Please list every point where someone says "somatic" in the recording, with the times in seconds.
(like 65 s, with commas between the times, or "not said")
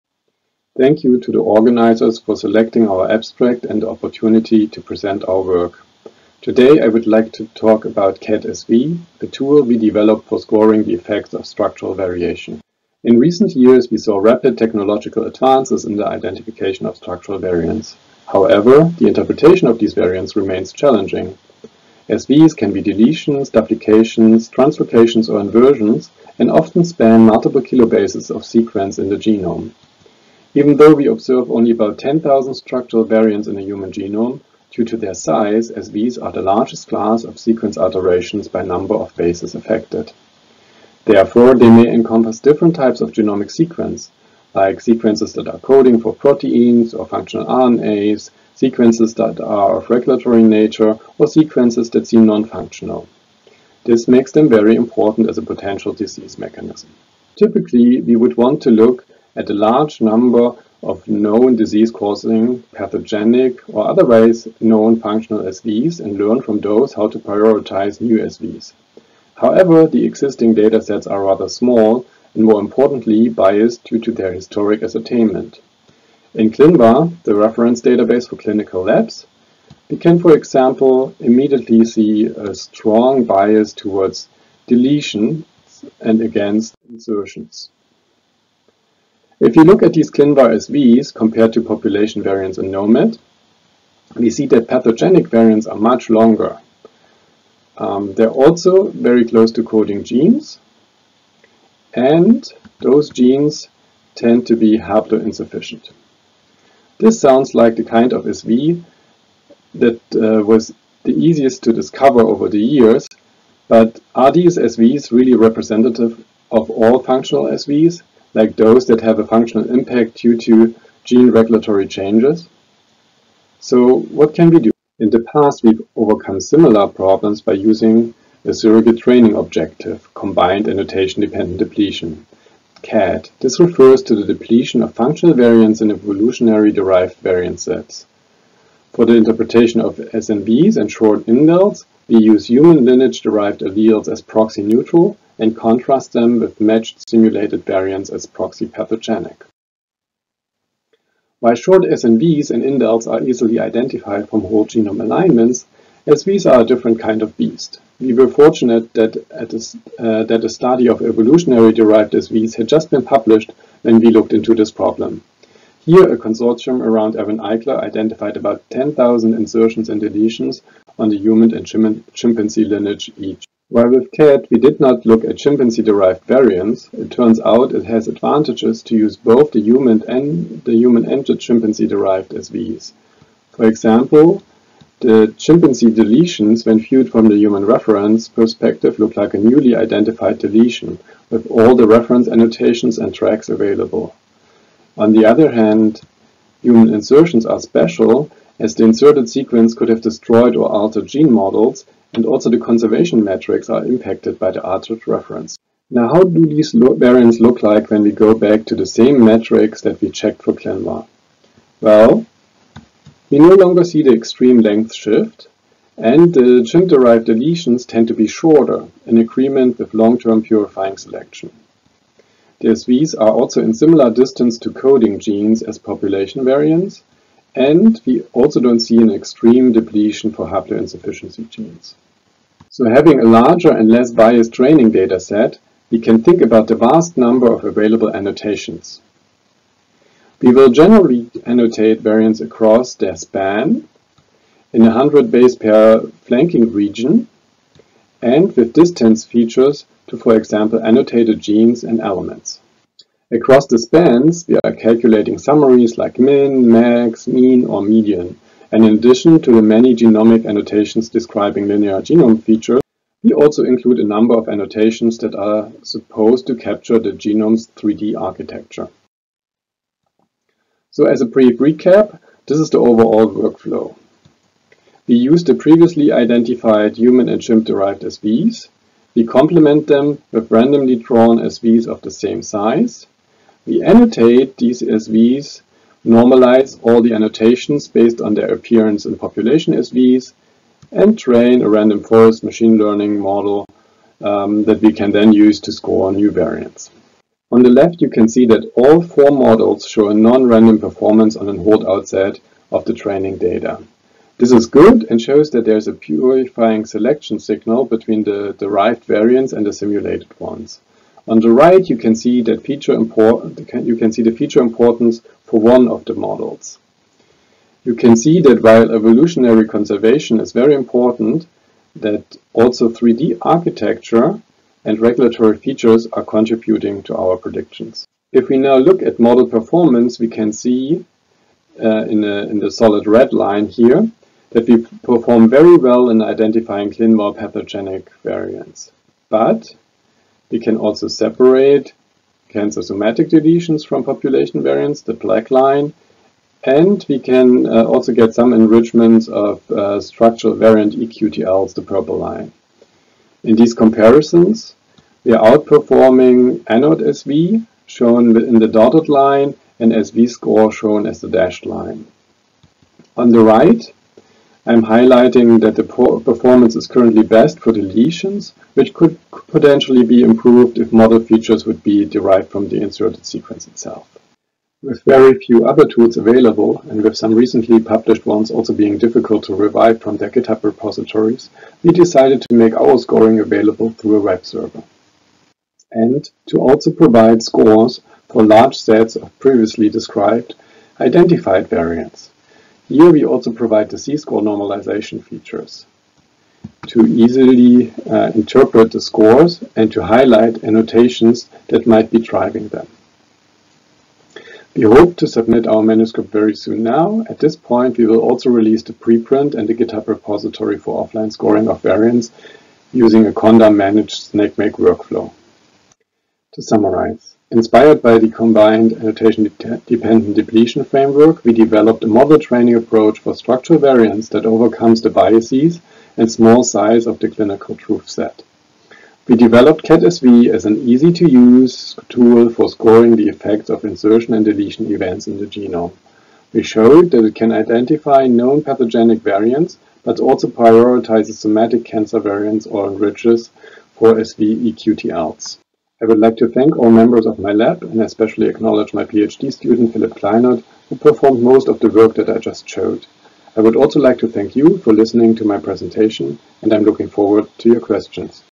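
342 s, 441 s.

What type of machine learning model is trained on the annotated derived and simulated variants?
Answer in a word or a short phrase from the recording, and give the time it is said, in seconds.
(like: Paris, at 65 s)
Random forest, at 291 s.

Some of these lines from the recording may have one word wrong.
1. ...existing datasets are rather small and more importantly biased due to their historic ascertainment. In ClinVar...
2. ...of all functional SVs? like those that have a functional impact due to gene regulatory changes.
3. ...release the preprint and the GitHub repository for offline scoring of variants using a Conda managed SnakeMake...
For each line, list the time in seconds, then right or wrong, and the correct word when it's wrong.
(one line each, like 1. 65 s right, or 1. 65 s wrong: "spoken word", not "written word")
1. 70 s right
2. 116 s right
3. 408 s right.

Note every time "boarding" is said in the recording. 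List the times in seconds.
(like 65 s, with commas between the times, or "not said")
not said.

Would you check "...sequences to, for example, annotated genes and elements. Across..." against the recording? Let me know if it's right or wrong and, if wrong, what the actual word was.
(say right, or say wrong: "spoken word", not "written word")
wrong: "features", not "sequences".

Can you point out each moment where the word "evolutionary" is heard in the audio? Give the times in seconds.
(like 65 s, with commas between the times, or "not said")
135 s, 161 s, 318 s.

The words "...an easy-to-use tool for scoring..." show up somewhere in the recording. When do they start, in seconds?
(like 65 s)
430 s.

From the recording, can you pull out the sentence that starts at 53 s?
This makes them very important as a potential disease mechanism.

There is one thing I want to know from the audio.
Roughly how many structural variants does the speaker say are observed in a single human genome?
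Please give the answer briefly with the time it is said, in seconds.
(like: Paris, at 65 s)
10,000, at 31 s.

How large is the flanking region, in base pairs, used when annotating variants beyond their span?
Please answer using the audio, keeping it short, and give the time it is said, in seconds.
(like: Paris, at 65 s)
100 base pairs, at 244 s.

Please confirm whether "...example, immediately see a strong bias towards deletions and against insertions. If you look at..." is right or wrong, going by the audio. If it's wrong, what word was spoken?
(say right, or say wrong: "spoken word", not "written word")
right.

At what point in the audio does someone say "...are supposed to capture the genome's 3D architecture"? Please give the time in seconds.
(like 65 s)
265 s.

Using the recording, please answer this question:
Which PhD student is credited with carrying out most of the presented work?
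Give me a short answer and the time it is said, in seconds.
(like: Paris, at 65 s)
Philip Kleinert, at 449 s.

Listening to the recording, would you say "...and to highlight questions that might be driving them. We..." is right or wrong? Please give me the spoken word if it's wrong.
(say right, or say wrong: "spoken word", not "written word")
wrong: "annotations", not "questions".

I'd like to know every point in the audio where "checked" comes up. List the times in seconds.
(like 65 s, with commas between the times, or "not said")
210 s.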